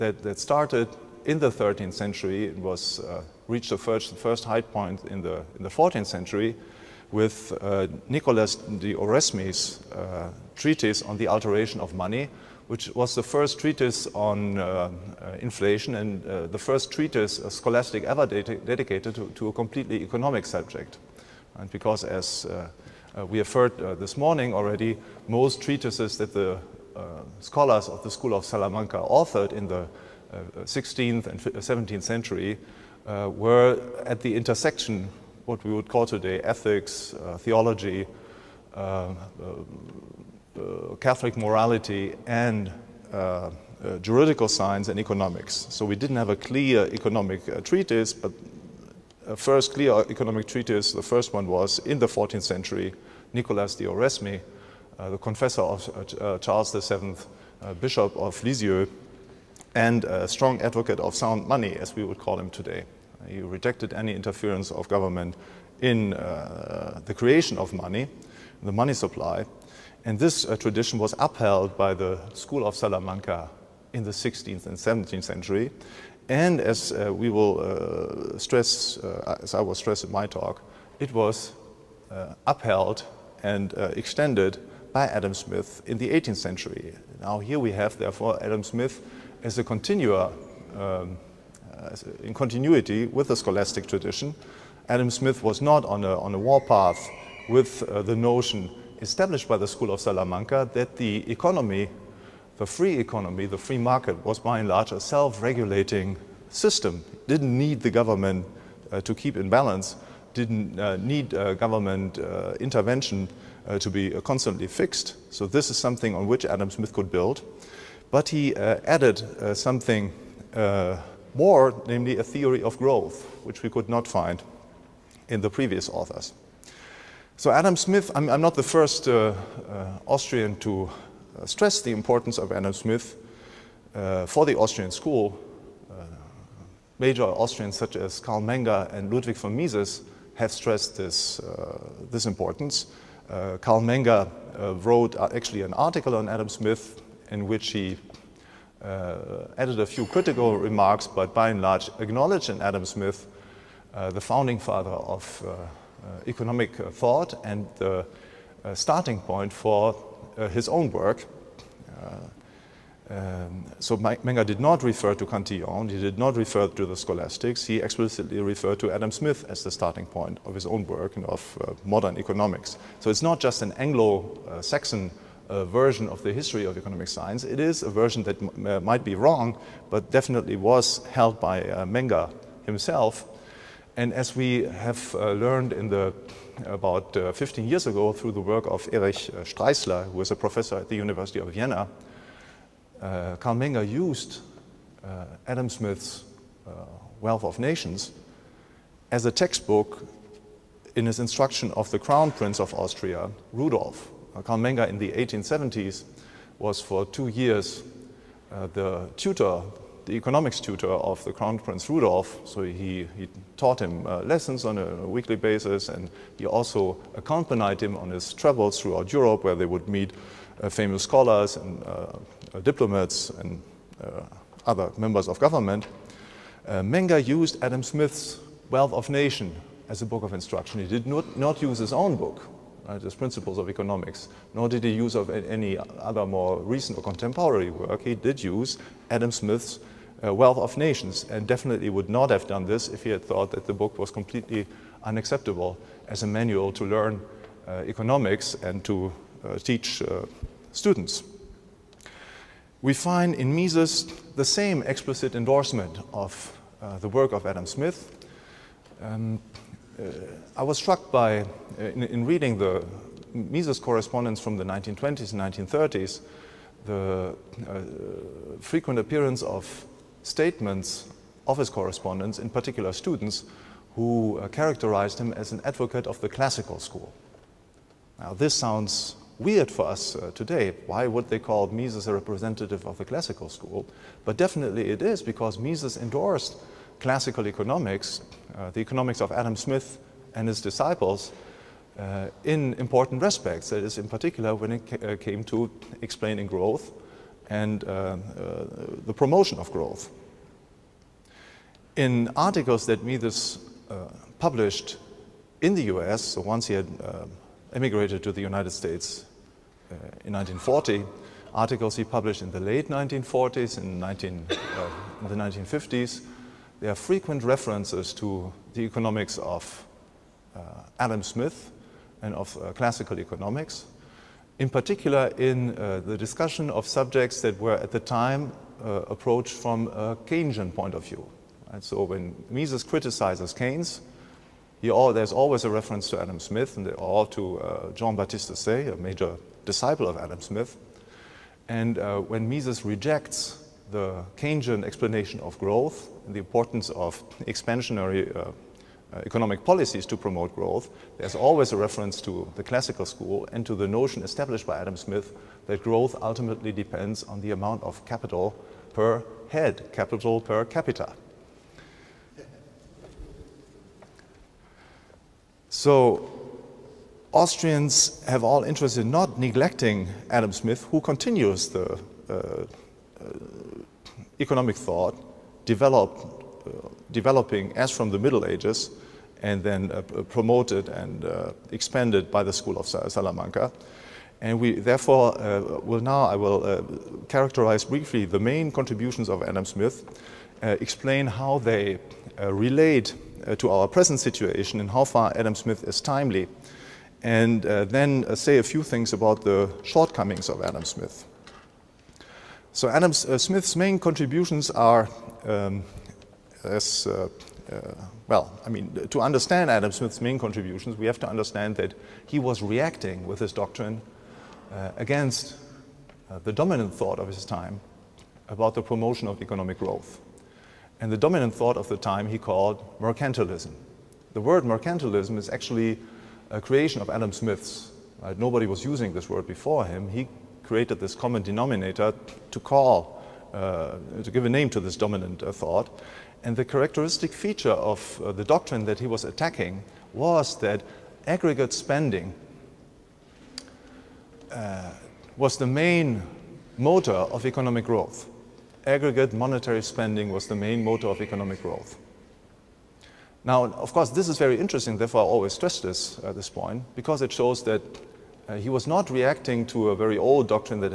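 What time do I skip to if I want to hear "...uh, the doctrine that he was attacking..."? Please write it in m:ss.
7:18.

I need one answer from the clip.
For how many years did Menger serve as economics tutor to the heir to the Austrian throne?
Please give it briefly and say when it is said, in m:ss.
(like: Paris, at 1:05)
2, at 3:27.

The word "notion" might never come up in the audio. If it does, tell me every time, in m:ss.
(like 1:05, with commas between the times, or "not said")
1:38, 5:53.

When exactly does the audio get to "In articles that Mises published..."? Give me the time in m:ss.
5:01.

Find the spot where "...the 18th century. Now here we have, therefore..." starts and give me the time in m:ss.
1:25.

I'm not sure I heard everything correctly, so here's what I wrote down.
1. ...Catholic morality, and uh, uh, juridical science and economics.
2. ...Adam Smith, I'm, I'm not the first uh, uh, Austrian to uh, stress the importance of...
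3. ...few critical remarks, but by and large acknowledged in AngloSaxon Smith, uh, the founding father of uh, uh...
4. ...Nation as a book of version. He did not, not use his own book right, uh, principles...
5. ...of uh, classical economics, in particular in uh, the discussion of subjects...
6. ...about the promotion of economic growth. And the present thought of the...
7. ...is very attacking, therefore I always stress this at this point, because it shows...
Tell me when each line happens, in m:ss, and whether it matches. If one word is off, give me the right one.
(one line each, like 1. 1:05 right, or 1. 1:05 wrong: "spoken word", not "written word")
1. 0:40 right
2. 2:07 right
3. 2:29 wrong: "Adam", not "AngloSaxon"
4. 3:49 wrong: "instruction", not "version"
5. 5:22 right
6. 6:58 wrong: "dominant", not "present"
7. 7:34 wrong: "interesting", not "attacking".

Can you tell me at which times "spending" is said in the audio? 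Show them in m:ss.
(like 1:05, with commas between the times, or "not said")
7:21, 7:29.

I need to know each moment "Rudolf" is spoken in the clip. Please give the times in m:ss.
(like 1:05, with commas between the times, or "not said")
3:23, 3:31.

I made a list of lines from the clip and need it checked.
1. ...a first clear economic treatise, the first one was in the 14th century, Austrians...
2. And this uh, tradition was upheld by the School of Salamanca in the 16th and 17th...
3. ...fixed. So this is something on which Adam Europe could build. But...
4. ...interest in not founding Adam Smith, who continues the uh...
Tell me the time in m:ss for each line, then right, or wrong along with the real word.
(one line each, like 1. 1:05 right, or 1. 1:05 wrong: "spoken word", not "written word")
1. 0:49 wrong: "Nicolas", not "Austrians"
2. 1:10 right
3. 1:54 wrong: "Smith", not "Europe"
4. 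6:08 wrong: "neglecting", not "founding".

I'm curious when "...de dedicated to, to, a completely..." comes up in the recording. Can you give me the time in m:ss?
0:18.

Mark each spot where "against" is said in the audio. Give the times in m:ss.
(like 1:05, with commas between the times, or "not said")
6:54.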